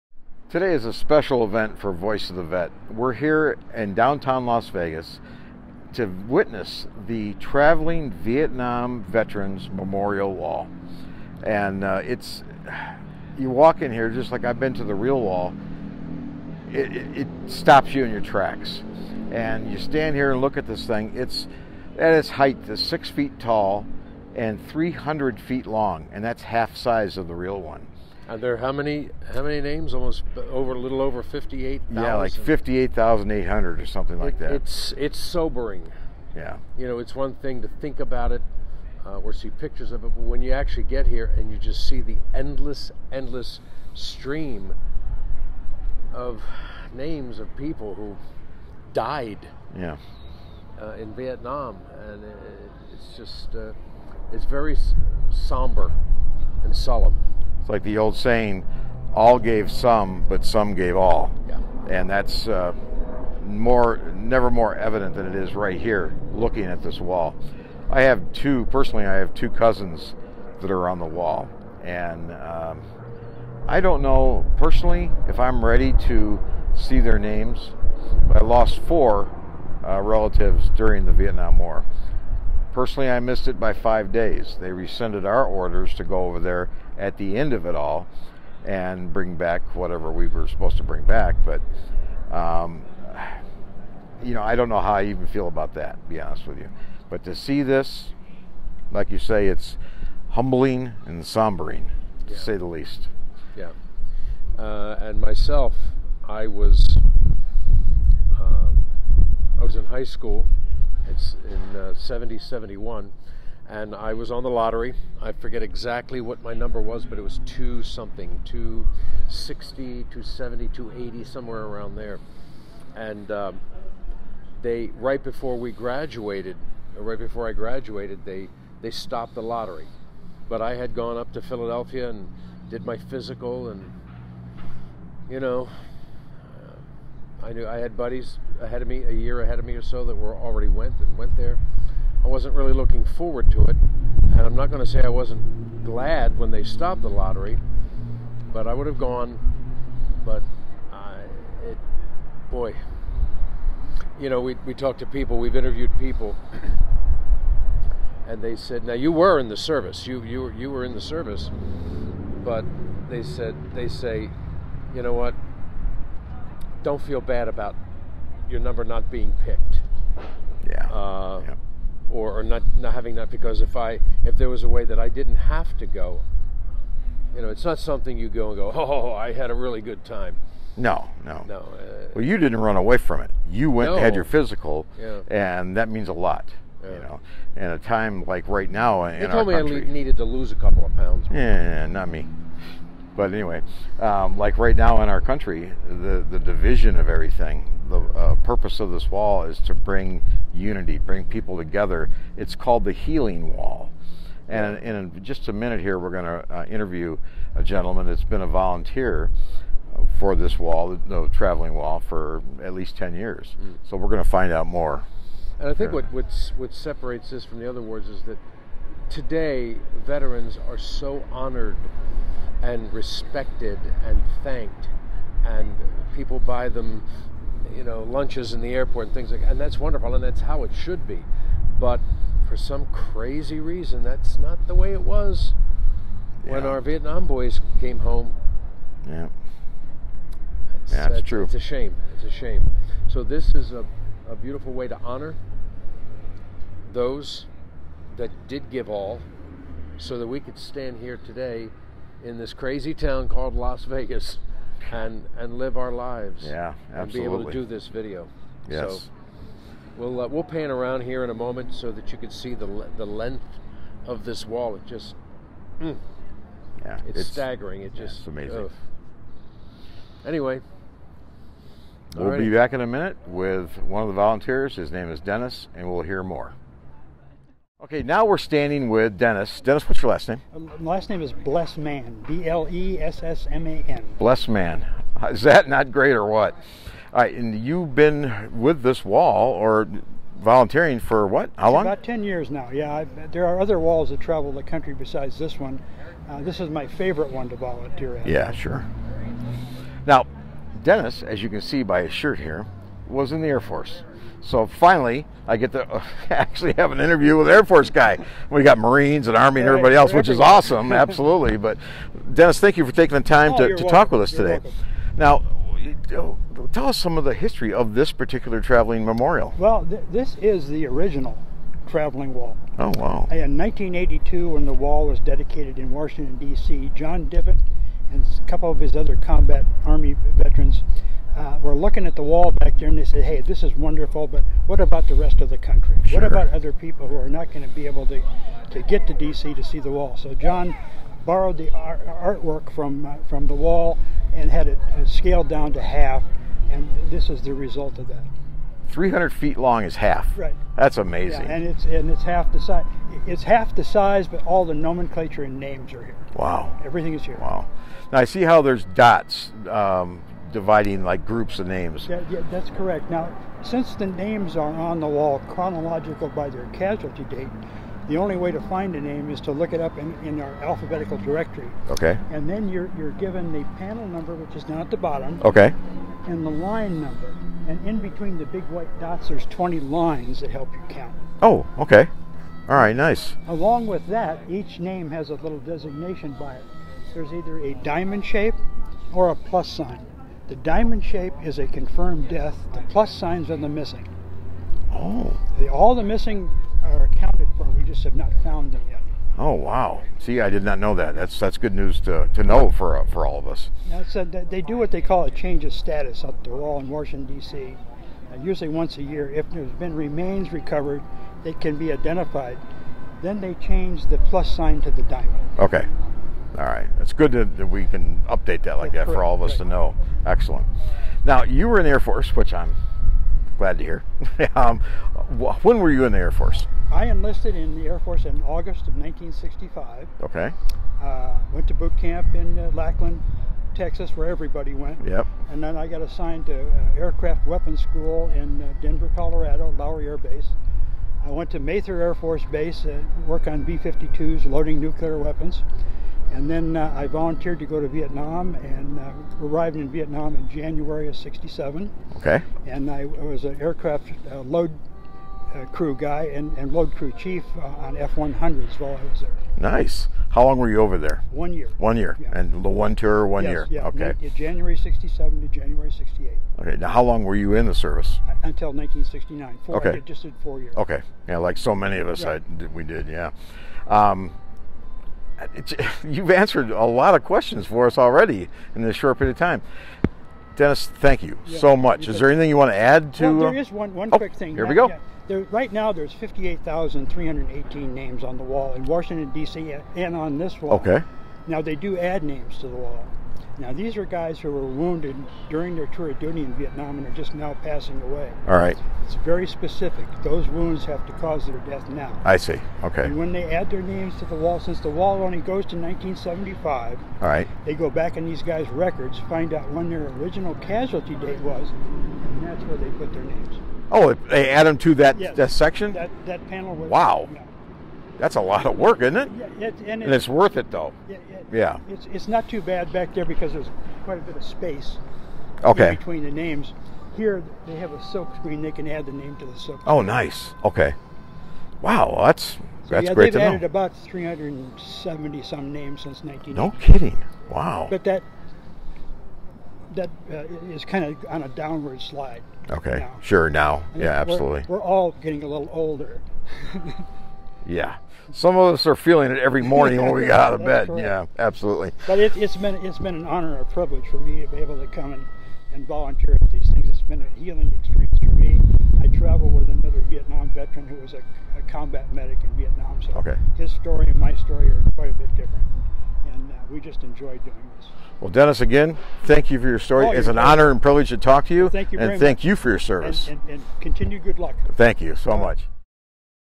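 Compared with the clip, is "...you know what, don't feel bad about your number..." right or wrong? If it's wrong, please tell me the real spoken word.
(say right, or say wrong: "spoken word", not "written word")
right.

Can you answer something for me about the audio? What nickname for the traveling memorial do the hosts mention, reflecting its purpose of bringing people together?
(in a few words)
the healing wall.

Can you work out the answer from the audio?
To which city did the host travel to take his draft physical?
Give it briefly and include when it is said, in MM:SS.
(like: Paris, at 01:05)
Philadelphia, at 02:11.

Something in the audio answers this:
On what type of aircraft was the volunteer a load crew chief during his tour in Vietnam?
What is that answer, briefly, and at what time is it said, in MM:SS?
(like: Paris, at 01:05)
F-100, at 07:37.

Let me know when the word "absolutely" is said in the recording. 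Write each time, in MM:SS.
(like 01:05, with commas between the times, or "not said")
04:16, 05:10, 09:04, 09:11.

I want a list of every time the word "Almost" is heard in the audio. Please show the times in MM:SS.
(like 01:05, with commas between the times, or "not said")
00:29.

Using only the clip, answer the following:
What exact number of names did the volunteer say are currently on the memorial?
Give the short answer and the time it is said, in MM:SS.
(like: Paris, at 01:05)
58,318, at 08:06.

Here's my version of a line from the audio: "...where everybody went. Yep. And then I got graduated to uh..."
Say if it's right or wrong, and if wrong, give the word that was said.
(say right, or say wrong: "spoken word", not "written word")
wrong: "assigned", not "graduated".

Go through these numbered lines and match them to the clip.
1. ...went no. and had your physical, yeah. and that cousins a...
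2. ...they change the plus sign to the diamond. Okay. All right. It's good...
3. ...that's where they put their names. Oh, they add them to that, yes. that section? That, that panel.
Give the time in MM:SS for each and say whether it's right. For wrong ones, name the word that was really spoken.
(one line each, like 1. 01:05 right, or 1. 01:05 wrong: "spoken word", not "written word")
1. 03:03 wrong: "means", not "cousins"
2. 06:53 right
3. 08:32 right.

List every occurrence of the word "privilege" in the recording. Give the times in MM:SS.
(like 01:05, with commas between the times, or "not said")
09:13, 09:30.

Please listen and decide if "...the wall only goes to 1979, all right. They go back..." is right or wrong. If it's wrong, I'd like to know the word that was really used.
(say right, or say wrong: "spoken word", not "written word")
wrong: "1975", not "1979".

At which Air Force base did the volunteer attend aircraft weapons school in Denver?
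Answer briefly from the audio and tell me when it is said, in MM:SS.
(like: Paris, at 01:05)
Lowry Air Base, at 07:19.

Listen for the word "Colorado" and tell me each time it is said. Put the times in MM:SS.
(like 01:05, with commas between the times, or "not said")
07:19.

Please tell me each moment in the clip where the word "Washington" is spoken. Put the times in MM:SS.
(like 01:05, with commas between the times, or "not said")
05:25, 06:46, 08:08.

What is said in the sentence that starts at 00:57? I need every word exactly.
It's like the old saying, all gave some, but some gave all.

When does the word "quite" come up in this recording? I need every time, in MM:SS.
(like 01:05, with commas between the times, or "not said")
08:44, 09:24.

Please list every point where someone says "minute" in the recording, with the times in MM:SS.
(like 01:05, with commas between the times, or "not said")
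03:25, 04:32.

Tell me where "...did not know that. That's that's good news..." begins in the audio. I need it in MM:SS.
06:40.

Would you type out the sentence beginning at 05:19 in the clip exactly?
Well, th this is the original traveling wall.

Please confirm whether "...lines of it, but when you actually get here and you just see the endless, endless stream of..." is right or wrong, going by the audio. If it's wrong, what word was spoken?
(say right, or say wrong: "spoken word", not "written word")
wrong: "pictures", not "lines".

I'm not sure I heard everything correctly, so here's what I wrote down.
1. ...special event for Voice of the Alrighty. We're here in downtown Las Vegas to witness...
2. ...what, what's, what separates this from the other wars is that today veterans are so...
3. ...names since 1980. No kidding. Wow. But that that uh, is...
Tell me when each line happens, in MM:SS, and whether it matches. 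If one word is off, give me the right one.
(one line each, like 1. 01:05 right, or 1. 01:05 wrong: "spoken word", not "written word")
1. 00:00 wrong: "Vet", not "Alrighty"
2. 03:35 right
3. 08:55 right.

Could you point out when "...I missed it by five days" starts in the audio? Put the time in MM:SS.
01:23.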